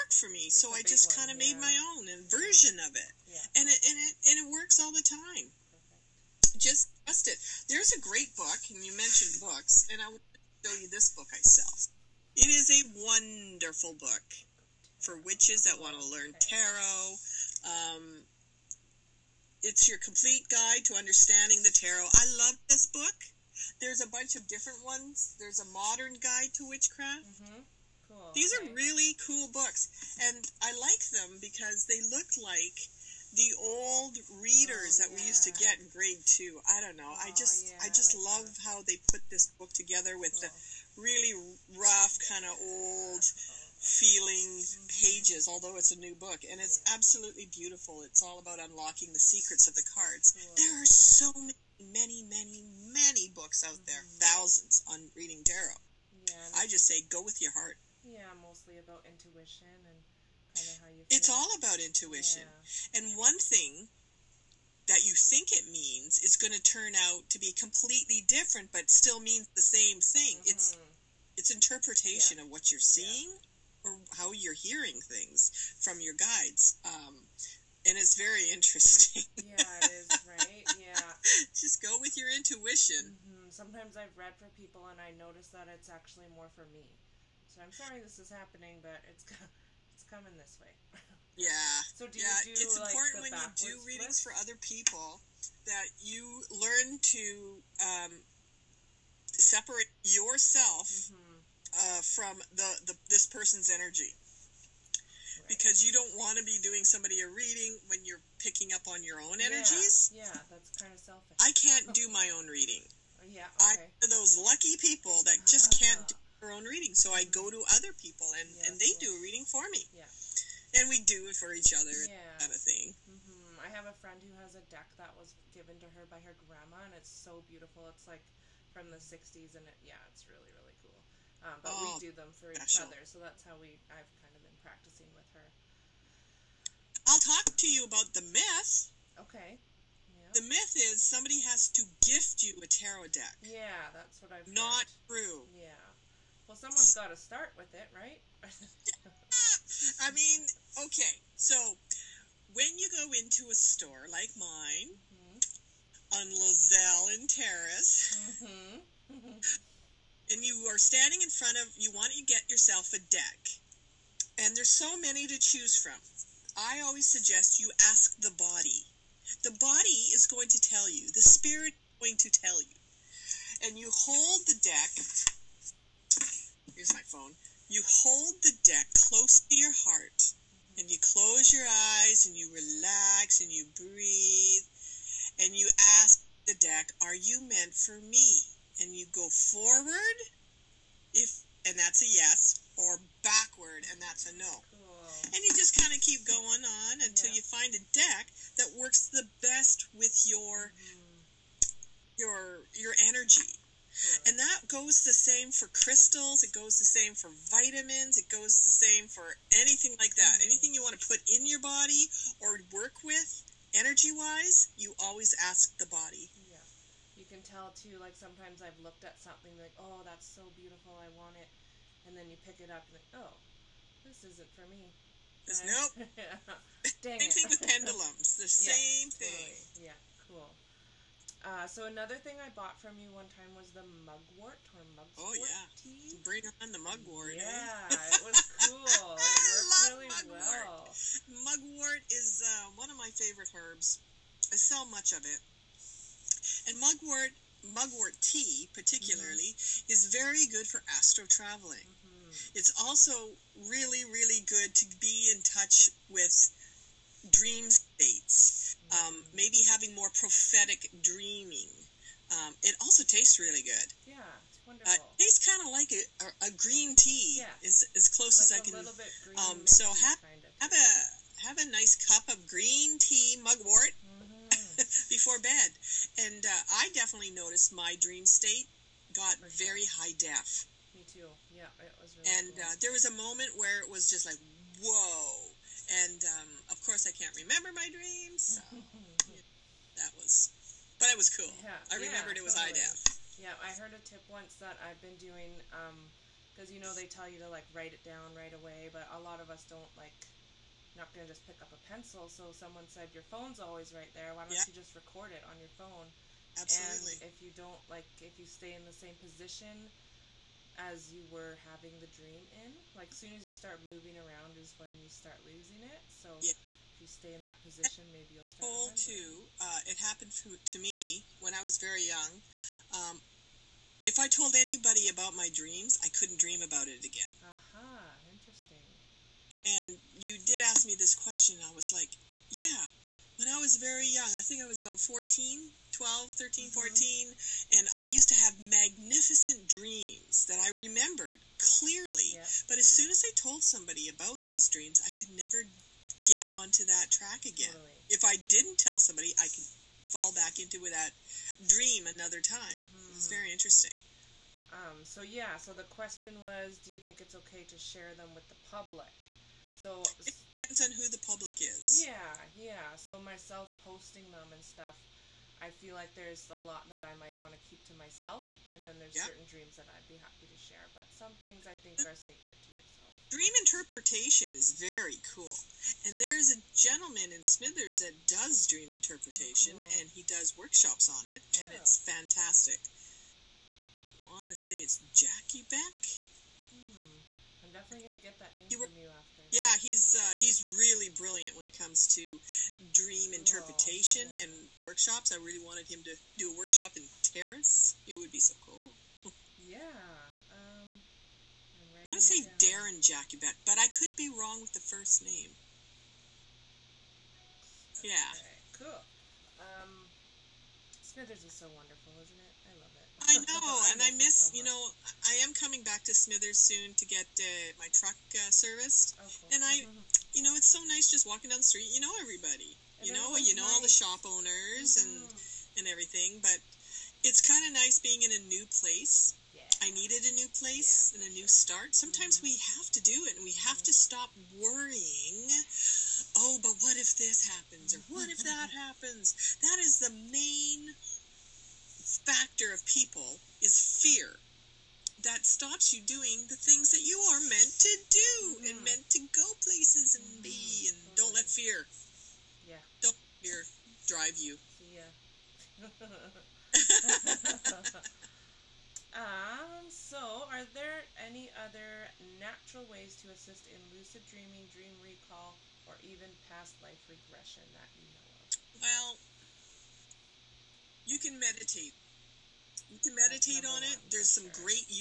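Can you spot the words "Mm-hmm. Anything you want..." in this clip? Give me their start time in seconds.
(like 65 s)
210 s.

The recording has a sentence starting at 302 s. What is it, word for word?
So someone said your phone's always right there.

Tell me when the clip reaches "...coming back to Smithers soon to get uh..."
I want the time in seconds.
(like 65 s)
415 s.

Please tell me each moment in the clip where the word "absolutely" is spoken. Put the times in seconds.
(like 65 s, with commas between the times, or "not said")
46 s, 306 s.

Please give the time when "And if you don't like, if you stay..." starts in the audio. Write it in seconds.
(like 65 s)
307 s.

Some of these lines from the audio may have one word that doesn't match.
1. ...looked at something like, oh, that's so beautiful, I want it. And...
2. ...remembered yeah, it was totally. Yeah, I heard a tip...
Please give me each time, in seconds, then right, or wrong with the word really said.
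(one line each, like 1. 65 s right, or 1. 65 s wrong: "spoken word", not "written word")
1. 218 s right
2. 292 s right.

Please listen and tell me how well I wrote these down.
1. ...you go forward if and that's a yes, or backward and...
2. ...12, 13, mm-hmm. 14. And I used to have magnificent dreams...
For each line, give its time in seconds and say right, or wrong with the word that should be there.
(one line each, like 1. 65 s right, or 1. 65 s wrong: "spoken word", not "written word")
1. 188 s right
2. 335 s right.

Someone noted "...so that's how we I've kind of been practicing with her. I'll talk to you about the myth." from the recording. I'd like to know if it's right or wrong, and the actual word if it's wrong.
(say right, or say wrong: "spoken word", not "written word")
right.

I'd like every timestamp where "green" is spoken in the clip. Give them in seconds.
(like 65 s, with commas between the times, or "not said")
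266 s, 272 s.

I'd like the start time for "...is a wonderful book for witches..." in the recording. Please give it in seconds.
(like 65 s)
12 s.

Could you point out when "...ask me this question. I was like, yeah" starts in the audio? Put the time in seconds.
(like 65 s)
330 s.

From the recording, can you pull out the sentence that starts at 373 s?
Dream interpretation is very cool, and there's a gentleman in Smithers that does dream interpretation, oh, cool.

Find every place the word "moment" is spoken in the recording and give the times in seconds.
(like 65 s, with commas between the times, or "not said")
283 s.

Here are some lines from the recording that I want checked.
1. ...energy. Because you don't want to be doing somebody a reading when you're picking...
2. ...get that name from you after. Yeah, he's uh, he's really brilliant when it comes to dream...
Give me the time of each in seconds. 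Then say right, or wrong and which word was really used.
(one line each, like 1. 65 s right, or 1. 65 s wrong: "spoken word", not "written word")
1. 103 s right
2. 388 s right.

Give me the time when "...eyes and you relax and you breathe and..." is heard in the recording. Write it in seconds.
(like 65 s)
181 s.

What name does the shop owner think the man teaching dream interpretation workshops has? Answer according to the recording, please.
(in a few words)
Darren Jacobet.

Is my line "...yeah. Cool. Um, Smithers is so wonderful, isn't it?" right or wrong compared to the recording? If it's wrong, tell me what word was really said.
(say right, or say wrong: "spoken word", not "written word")
right.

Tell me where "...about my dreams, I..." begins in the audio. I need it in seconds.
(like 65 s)
325 s.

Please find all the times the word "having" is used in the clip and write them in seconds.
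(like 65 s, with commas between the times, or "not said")
259 s, 311 s.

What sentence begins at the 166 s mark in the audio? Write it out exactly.
I always suggest you ask the body.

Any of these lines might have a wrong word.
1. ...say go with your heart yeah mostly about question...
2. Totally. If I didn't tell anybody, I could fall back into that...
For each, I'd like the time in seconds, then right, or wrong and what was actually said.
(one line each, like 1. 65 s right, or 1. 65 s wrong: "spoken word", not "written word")
1. 56 s wrong: "intuition", not "question"
2. 347 s wrong: "somebody", not "anybody".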